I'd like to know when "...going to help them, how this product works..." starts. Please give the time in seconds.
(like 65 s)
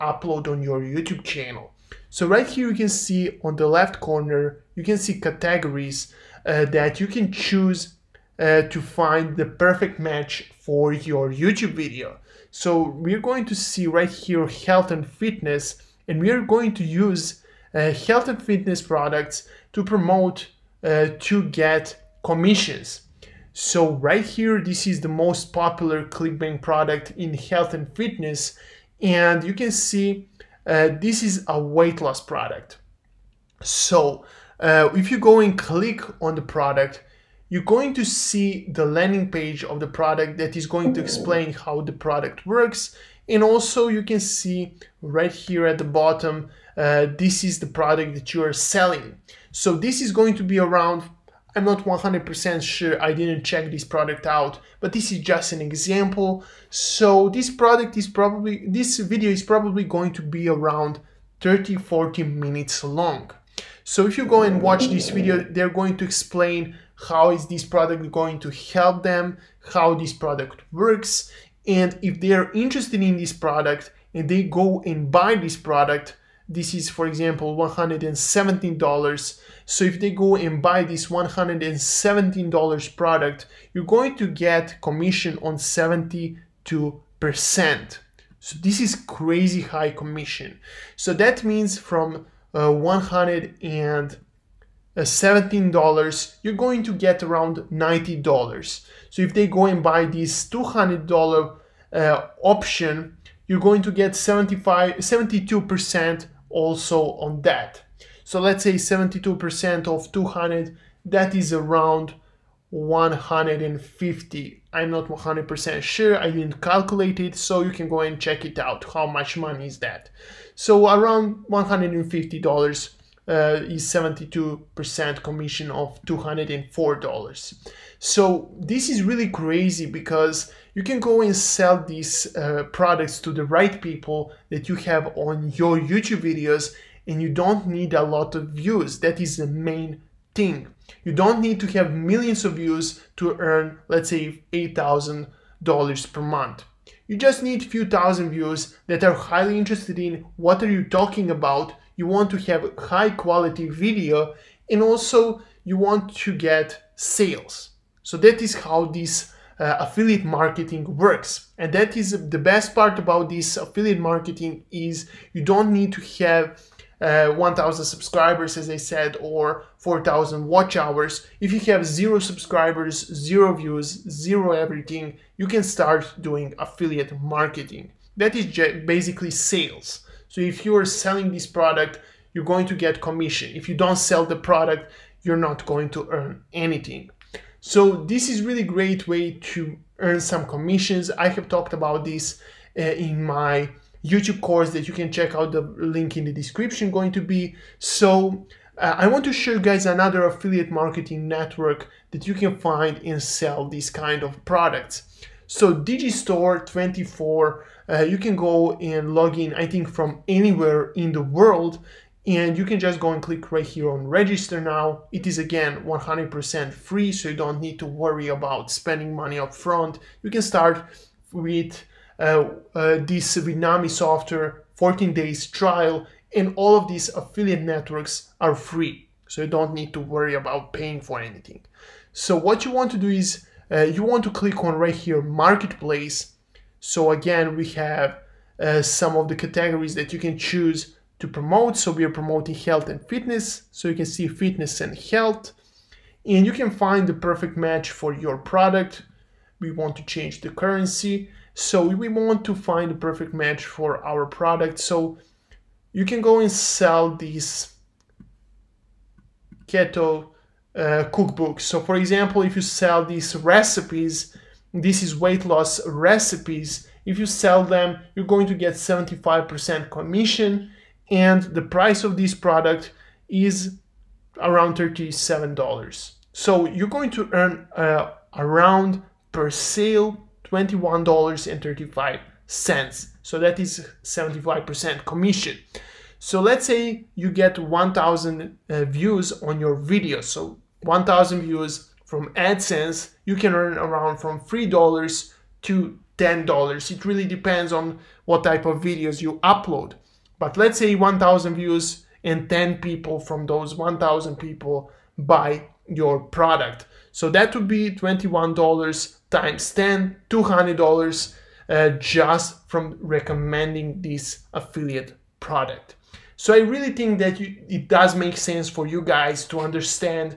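68 s.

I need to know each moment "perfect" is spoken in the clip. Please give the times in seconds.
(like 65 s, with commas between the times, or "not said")
9 s, 247 s, 252 s.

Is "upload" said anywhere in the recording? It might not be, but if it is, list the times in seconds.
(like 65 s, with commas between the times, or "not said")
0 s, 299 s.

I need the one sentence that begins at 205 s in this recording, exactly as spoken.
So Digistore 24 uh, you can go and log in, I think, from anywhere in the world.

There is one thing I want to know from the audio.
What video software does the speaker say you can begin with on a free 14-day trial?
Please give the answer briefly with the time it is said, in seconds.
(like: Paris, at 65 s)
Vidnami, at 223 s.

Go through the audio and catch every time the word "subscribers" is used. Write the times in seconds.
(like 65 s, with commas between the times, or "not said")
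167 s, 172 s.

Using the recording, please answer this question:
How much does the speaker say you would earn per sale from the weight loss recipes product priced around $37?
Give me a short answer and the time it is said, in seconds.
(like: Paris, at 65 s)
$21.35, at 280 s.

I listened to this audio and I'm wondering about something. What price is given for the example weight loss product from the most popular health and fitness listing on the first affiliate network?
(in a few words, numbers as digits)
$117.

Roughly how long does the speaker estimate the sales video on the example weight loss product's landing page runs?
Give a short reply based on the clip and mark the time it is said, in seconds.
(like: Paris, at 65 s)
30-40 minutes, at 61 s.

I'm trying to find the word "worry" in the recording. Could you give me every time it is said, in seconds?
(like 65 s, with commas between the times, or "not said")
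217 s, 230 s.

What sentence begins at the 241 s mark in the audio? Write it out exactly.
So we are promoting health and fitness.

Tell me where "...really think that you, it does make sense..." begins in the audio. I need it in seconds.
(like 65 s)
316 s.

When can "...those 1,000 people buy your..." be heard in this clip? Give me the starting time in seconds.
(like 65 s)
303 s.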